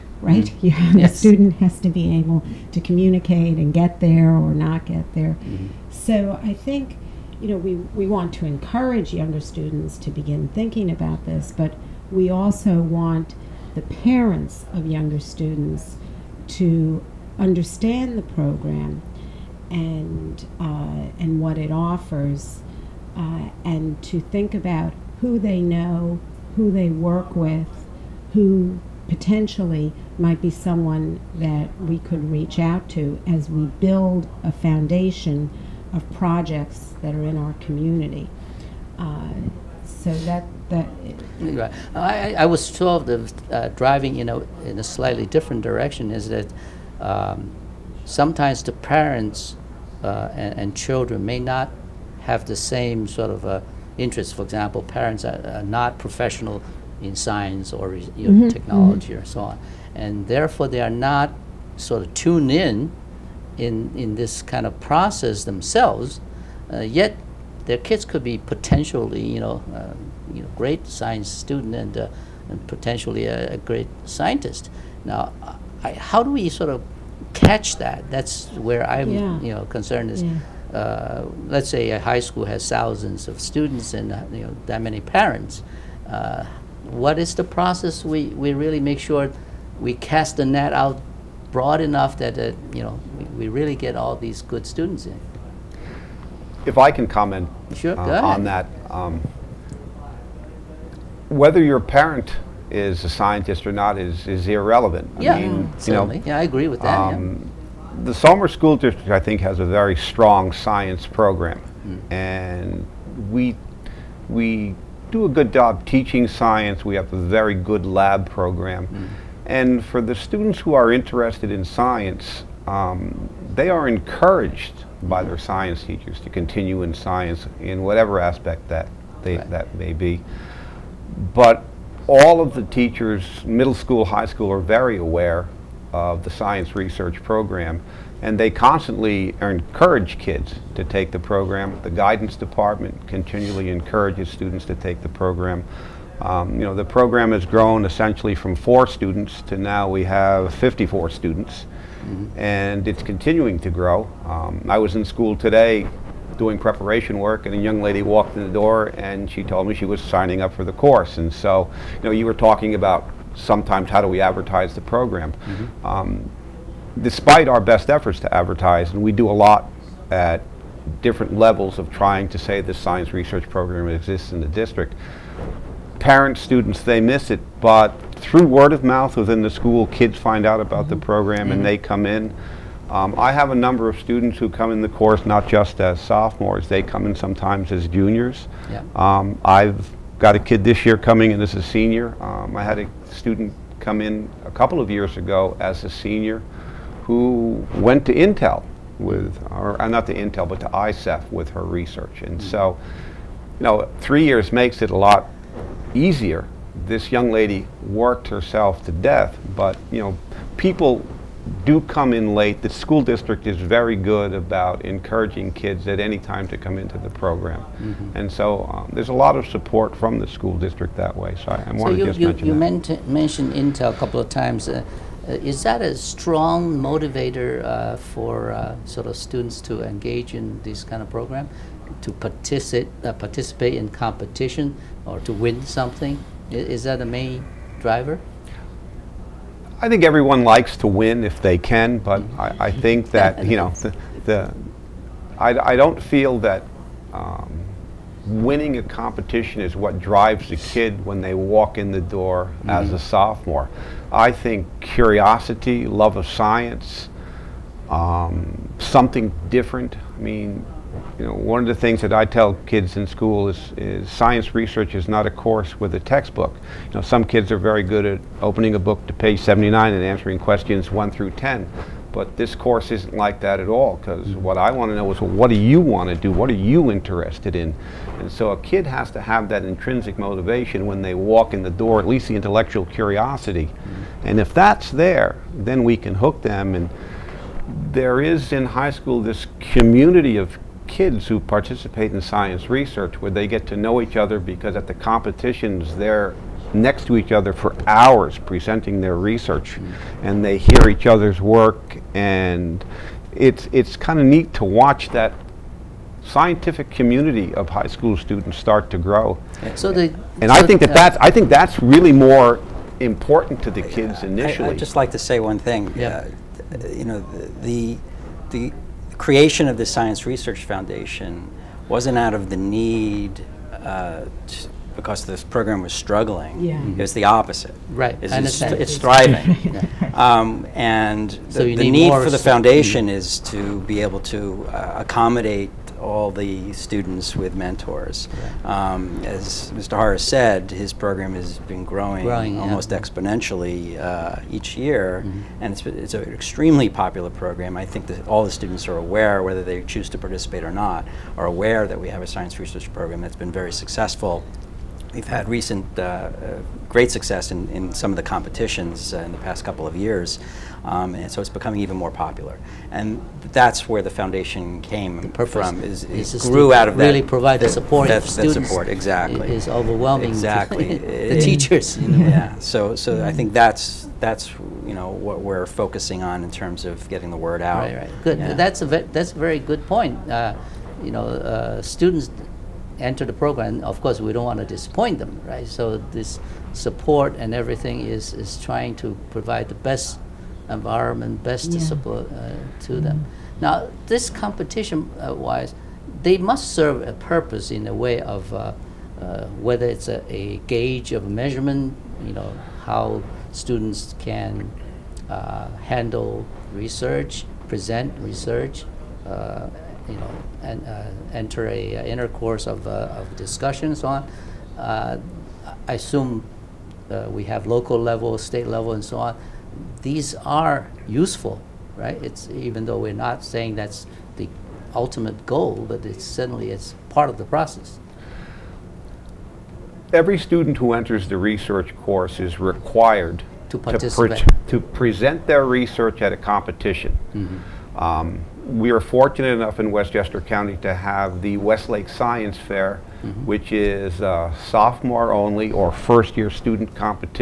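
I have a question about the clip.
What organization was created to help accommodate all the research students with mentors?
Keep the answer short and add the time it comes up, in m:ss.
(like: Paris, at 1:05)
Science Research Foundation, at 5:19.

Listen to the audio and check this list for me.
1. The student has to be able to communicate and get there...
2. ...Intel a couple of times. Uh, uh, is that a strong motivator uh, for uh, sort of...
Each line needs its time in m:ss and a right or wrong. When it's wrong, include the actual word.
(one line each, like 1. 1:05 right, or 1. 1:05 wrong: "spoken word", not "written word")
1. 0:01 right
2. 3:43 right.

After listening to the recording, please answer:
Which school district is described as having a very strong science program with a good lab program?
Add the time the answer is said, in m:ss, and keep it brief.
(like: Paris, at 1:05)
Somers School District, at 1:48.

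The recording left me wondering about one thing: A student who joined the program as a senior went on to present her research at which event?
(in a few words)
ISEF.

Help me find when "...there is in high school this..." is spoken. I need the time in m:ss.
4:47.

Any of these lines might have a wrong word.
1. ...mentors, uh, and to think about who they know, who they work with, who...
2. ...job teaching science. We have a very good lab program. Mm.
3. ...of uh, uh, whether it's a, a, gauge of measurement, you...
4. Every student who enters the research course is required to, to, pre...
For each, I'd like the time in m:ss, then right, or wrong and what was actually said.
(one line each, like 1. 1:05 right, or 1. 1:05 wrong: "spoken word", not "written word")
1. 0:21 wrong: "offers", not "mentors"
2. 1:55 right
3. 6:38 right
4. 7:10 right.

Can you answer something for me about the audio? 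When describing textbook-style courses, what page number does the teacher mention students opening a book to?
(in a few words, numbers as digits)
79.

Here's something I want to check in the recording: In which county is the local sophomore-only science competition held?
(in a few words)
Westchester County.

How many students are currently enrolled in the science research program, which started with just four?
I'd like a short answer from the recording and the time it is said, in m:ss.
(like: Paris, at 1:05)
54, at 2:30.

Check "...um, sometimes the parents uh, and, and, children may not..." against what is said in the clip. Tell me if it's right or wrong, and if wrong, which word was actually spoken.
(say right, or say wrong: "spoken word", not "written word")
right.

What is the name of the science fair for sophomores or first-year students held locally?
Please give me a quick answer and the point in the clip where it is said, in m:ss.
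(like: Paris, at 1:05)
Westlake Science Fair, at 7:21.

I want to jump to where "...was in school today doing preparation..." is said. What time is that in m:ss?
2:34.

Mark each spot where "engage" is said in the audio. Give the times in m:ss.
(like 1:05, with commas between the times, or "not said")
3:49.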